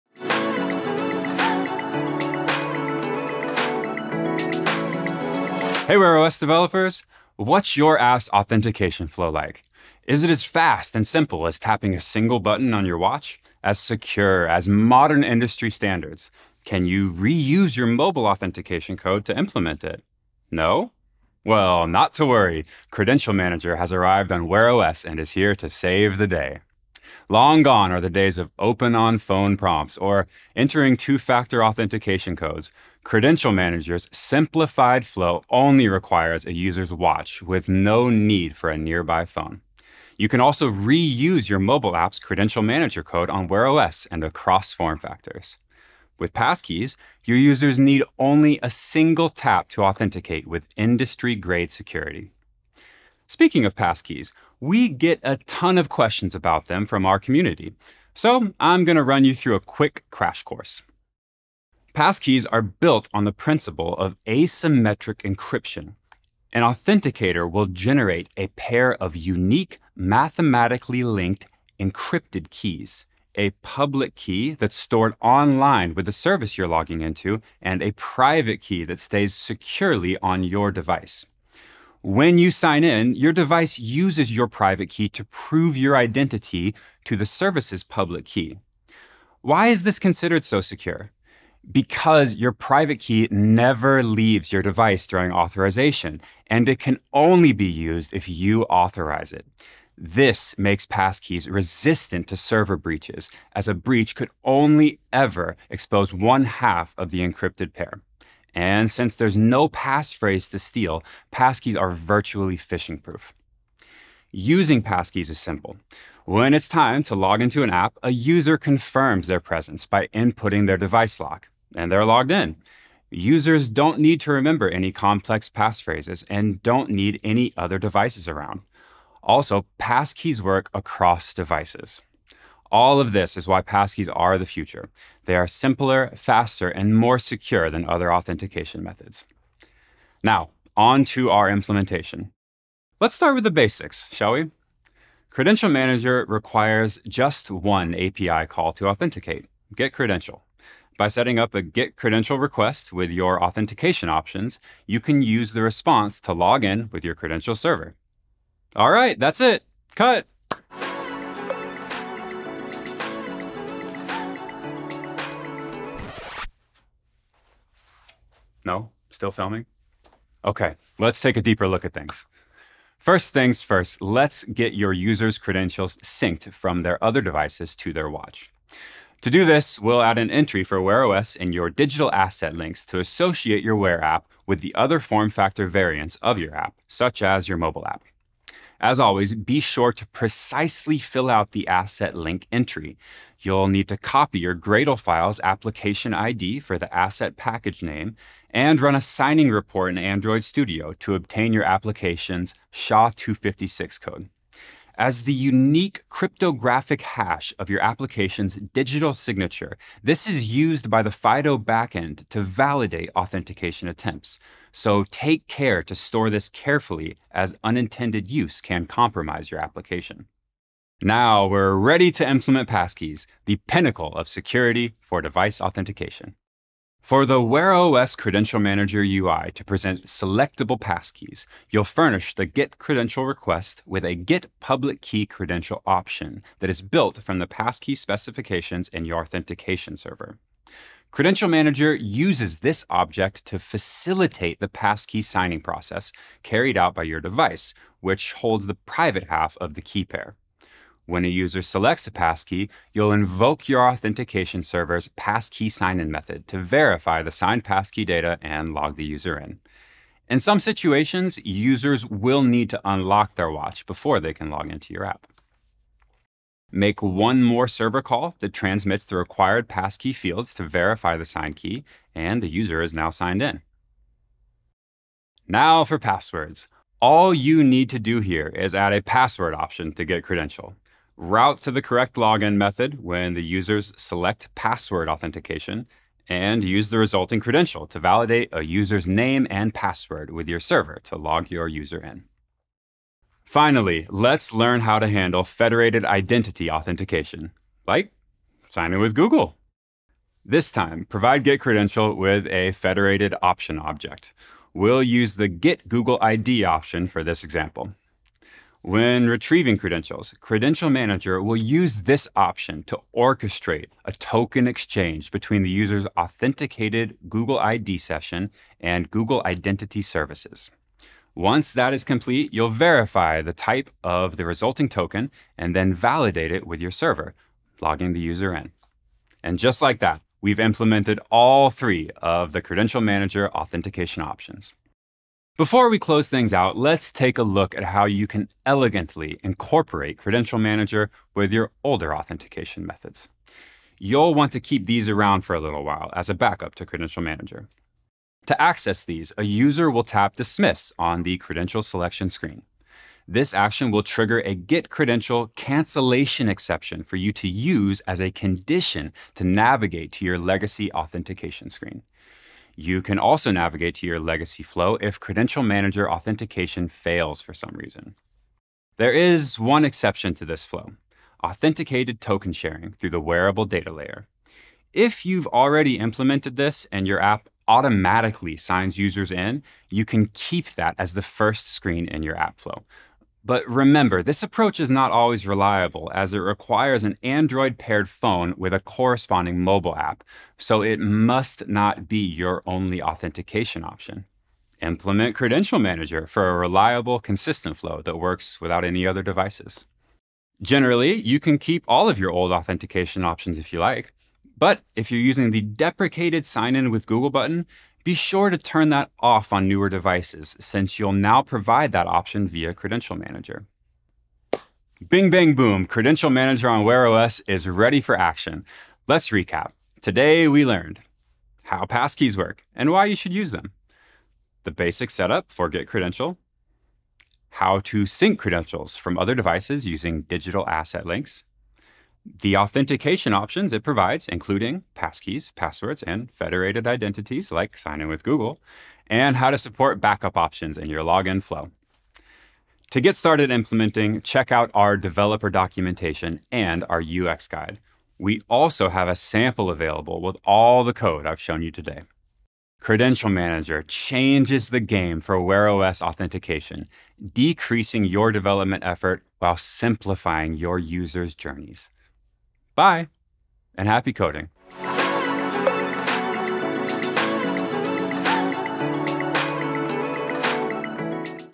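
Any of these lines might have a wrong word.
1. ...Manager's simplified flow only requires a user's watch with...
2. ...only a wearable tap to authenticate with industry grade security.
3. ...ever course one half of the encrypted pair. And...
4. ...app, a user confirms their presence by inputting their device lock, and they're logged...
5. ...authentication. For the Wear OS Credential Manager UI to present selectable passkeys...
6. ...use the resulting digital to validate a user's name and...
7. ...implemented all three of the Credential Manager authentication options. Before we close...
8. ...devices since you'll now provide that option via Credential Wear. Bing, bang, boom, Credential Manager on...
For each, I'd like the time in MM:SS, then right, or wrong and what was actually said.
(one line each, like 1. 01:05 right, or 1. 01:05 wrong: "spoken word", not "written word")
1. 00:33 right
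2. 00:48 wrong: "single", not "wearable"
3. 01:45 wrong: "expose", not "course"
4. 01:57 right
5. 03:45 right
6. 04:46 wrong: "credential", not "digital"
7. 05:30 right
8. 06:49 wrong: "Manager", not "Wear".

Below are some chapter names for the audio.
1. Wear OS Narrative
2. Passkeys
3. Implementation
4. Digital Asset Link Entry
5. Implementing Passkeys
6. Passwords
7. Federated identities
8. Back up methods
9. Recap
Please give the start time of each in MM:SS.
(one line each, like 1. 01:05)
1. 00:27
2. 00:53
3. 02:21
4. 03:01
5. 03:42
6. 04:36
7. 04:54
8. 05:40
9. 07:00.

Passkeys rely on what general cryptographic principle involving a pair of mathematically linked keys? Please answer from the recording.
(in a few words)
asymmetric encryption.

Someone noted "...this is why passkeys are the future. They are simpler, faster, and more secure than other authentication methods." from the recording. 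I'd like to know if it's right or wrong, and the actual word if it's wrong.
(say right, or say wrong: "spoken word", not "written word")
right.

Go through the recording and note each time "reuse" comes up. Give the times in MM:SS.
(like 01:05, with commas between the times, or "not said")
00:17, 00:40.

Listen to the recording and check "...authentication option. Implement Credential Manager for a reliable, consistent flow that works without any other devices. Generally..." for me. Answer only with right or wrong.
right.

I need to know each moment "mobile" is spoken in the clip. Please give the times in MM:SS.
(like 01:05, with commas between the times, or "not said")
00:17, 00:41, 03:07, 06:29.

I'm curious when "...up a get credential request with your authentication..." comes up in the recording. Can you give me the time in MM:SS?
02:31.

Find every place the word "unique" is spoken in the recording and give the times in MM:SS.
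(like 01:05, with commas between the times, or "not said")
01:09, 03:25.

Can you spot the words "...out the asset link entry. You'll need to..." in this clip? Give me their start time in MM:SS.
03:11.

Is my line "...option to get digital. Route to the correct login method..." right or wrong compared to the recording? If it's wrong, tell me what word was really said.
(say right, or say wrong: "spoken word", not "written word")
wrong: "credential", not "digital".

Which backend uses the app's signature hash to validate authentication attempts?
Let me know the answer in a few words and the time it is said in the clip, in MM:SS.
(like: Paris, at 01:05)
FIDO, at 03:31.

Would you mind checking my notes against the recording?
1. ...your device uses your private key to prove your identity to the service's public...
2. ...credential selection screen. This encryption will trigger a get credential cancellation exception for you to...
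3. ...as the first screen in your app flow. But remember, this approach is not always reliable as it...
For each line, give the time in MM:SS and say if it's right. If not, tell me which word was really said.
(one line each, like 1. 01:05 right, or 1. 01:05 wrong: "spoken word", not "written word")
1. 01:23 right
2. 05:51 wrong: "action", not "encryption"
3. 06:20 right.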